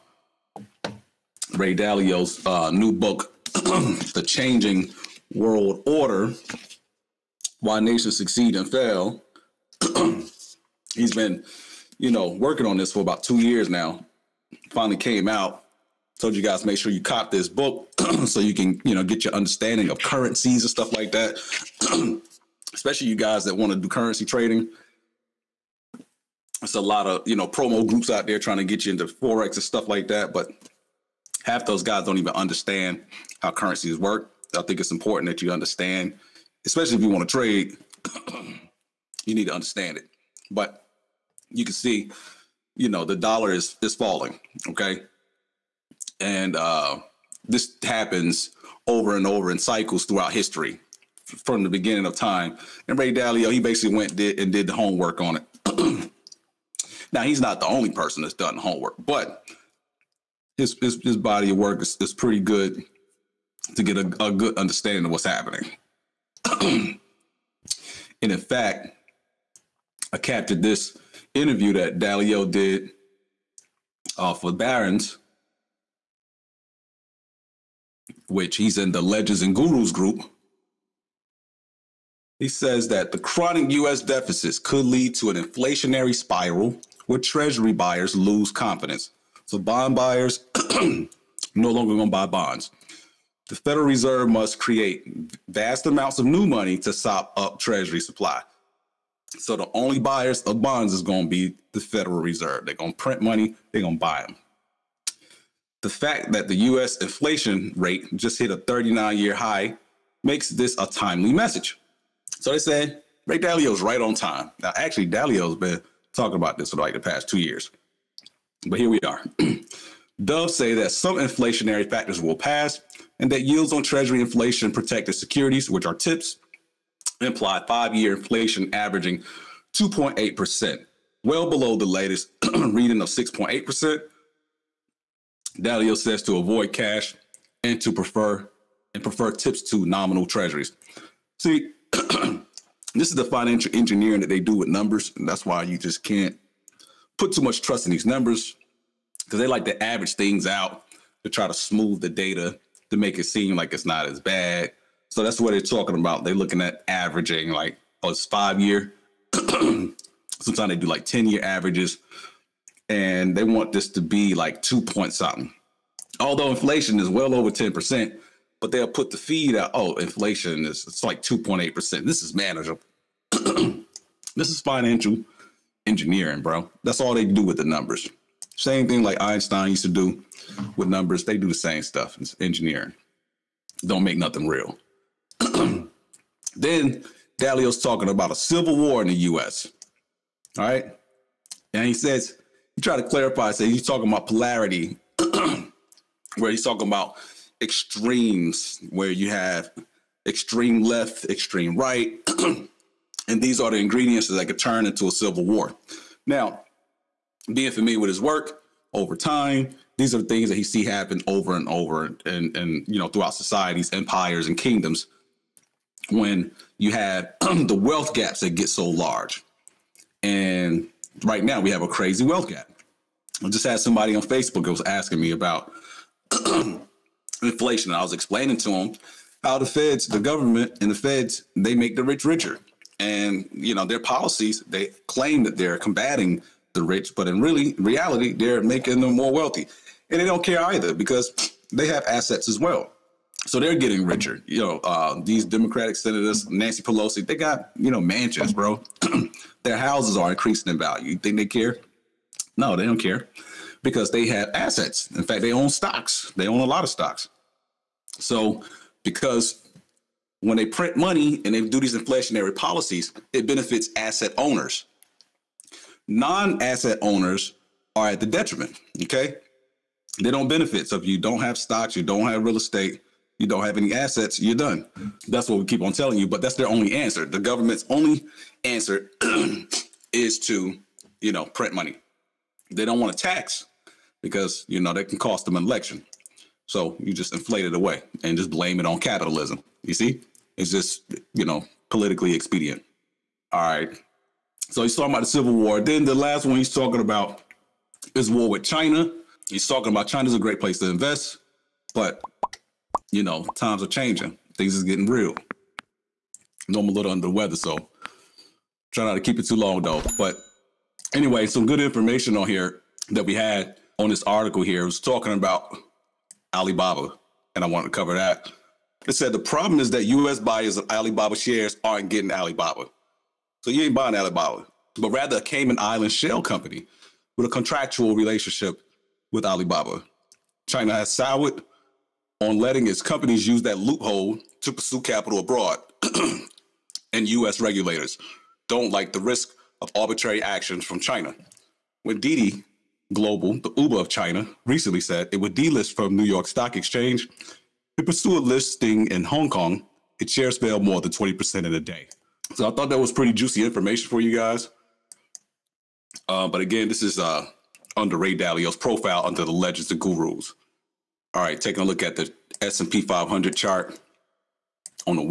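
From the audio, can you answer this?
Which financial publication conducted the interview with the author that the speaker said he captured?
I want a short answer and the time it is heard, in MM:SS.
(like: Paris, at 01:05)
Barron's, at 01:14.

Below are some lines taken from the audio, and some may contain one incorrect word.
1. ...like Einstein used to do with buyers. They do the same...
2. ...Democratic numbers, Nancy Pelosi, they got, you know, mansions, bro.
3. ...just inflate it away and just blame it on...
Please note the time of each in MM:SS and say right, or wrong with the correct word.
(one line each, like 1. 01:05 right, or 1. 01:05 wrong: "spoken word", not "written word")
1. 02:59 wrong: "numbers", not "buyers"
2. 04:05 wrong: "senators", not "numbers"
3. 04:47 right.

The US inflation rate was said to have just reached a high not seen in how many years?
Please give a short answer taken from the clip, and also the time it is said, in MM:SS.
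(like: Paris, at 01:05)
39, at 01:48.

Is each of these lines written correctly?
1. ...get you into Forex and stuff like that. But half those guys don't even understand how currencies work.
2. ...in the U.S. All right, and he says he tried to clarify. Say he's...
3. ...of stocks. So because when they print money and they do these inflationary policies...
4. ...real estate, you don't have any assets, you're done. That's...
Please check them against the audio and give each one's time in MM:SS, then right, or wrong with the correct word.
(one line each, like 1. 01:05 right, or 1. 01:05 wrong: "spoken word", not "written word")
1. 00:28 right
2. 03:09 right
3. 04:16 right
4. 04:32 right.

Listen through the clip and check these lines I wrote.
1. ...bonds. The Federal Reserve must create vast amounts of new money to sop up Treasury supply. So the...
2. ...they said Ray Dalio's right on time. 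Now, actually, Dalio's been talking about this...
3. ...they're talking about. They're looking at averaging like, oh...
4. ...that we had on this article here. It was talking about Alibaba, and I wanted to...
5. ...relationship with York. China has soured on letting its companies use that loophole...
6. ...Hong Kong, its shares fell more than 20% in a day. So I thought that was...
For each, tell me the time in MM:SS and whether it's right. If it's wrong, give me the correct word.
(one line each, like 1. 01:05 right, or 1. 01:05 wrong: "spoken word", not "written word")
1. 01:32 right
2. 01:52 right
3. 02:35 right
4. 05:13 right
5. 05:28 wrong: "Alibaba", not "York"
6. 05:49 right.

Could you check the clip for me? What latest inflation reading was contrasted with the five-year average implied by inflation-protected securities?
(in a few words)
6.8%.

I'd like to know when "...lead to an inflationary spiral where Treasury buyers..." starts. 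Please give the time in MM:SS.
01:24.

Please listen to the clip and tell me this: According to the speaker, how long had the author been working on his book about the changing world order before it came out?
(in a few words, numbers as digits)
about two years.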